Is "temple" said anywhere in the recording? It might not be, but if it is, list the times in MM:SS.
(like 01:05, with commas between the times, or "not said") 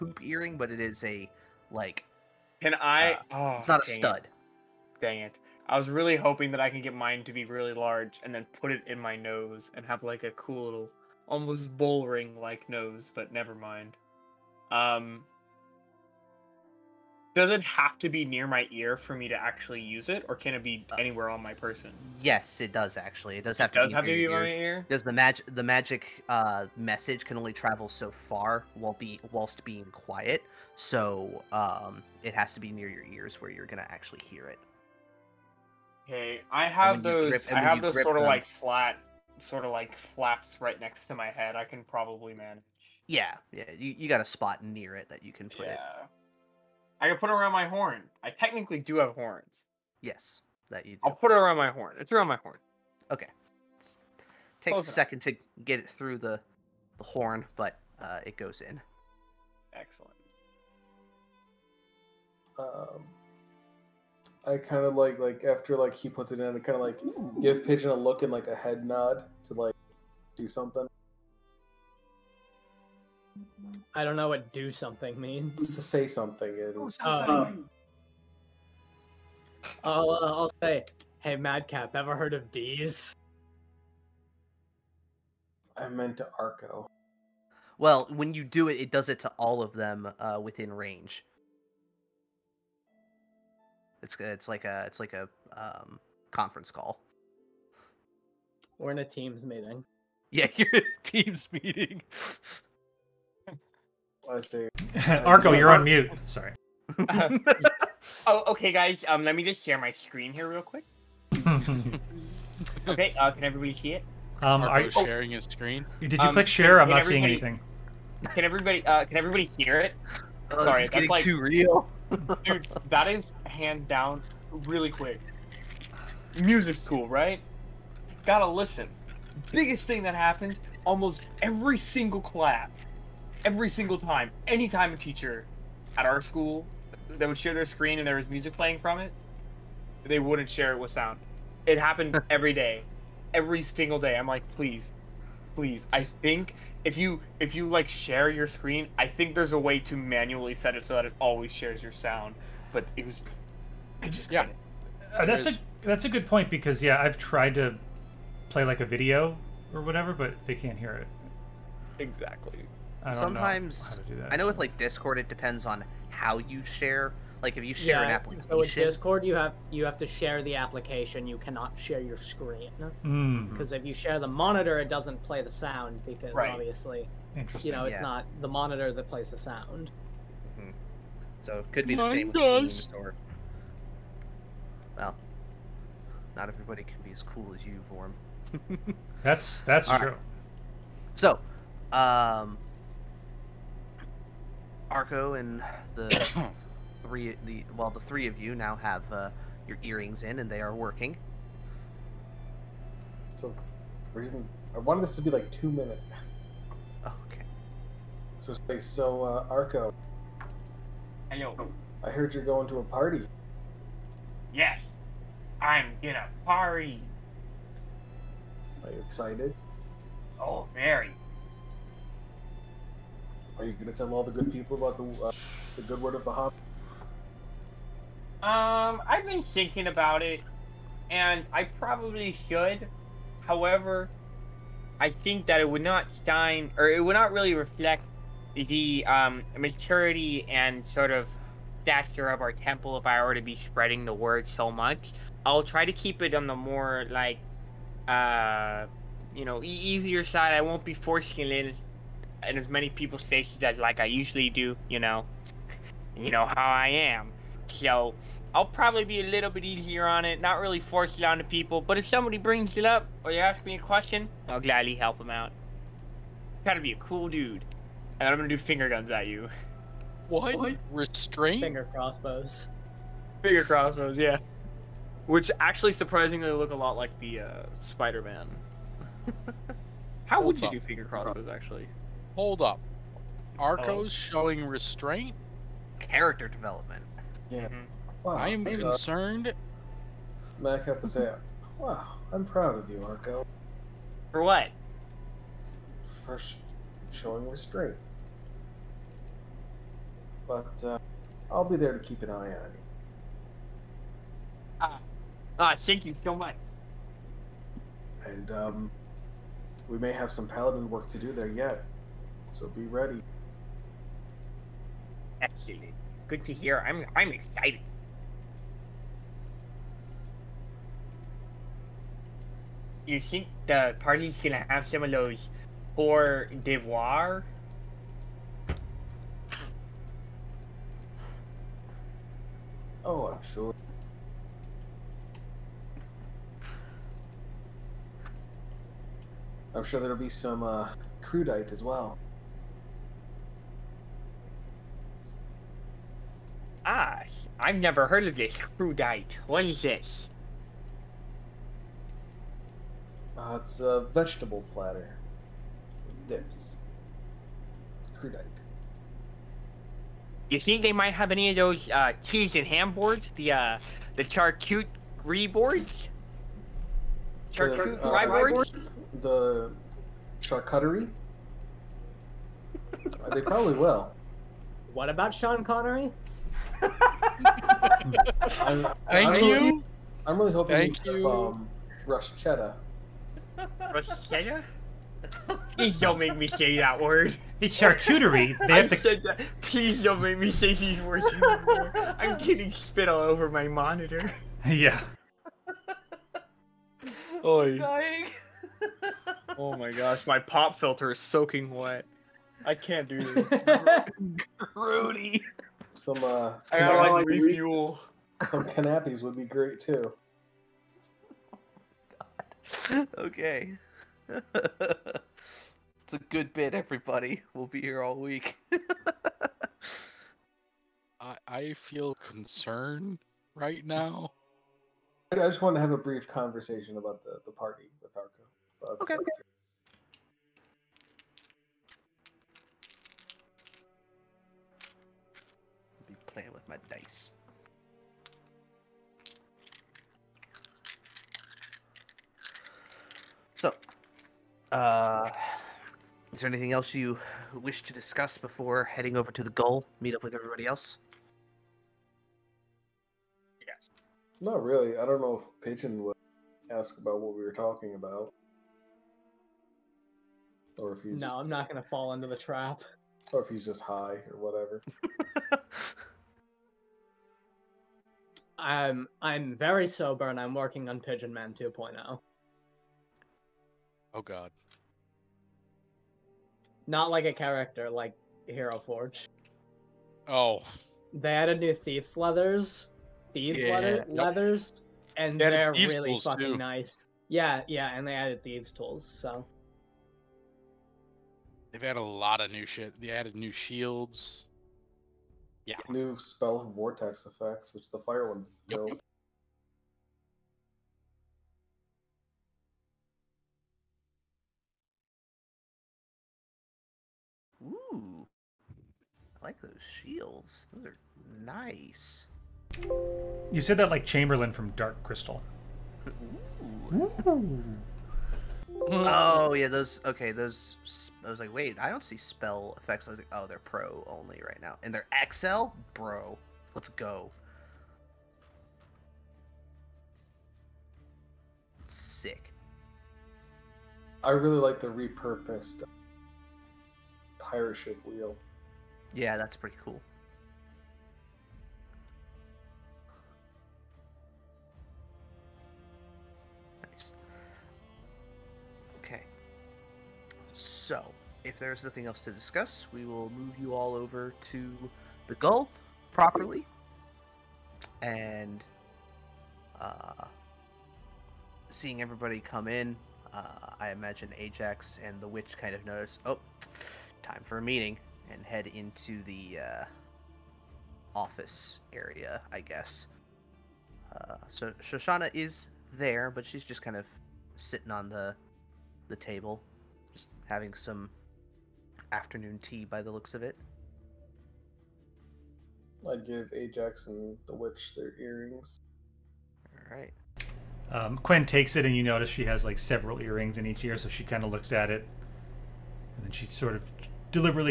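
04:02.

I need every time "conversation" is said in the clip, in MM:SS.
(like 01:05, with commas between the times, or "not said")
07:06.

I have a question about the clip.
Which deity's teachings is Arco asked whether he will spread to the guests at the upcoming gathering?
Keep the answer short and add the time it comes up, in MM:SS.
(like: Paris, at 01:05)
Bahamut, at 03:46.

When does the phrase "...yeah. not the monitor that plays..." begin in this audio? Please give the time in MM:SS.
02:57.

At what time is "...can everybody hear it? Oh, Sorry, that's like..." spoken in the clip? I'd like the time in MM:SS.
01:59.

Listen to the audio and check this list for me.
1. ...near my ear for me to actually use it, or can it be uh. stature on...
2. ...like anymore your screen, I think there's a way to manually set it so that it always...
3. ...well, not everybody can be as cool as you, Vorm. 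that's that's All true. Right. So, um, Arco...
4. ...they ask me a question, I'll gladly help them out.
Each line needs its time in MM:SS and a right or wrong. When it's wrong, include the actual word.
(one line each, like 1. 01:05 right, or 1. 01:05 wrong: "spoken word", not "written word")
1. 00:18 wrong: "anywhere", not "stature"
2. 02:27 wrong: "share", not "anymore"
3. 03:04 right
4. 04:23 right.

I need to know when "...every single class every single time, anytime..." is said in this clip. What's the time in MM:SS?
02:11.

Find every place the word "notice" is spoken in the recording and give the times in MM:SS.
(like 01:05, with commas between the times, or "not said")
09:25, 09:52.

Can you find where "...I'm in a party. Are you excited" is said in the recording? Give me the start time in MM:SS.
03:35.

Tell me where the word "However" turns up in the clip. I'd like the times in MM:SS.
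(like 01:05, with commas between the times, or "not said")
03:53.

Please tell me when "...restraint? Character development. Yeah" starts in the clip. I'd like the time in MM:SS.
04:44.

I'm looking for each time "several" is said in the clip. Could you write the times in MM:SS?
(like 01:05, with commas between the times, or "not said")
09:52.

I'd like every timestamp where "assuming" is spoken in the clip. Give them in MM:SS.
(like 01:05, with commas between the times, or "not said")
not said.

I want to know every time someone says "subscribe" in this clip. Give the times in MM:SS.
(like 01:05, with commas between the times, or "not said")
not said.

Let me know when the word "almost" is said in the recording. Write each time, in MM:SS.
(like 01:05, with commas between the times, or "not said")
00:11, 02:10.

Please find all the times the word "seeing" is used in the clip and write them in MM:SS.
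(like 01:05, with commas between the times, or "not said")
01:57, 09:21.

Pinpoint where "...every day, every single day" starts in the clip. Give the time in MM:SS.
02:22.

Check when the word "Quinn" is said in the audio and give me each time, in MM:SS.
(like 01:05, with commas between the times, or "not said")
09:51.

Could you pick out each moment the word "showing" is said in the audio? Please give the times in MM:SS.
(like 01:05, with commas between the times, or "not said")
04:44, 04:57.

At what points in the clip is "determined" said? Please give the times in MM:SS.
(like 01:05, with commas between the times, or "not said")
not said.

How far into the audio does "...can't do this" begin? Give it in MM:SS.
06:42.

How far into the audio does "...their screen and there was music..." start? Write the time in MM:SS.
02:17.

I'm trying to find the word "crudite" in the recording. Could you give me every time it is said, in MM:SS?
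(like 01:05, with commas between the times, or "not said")
05:41, 05:48, 05:58.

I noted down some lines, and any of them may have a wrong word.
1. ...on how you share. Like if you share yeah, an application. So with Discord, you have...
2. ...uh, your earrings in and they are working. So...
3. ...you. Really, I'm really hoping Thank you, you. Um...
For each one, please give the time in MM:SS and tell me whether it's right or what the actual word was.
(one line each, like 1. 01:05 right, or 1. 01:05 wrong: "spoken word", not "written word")
1. 02:45 right
2. 03:19 right
3. 06:19 right.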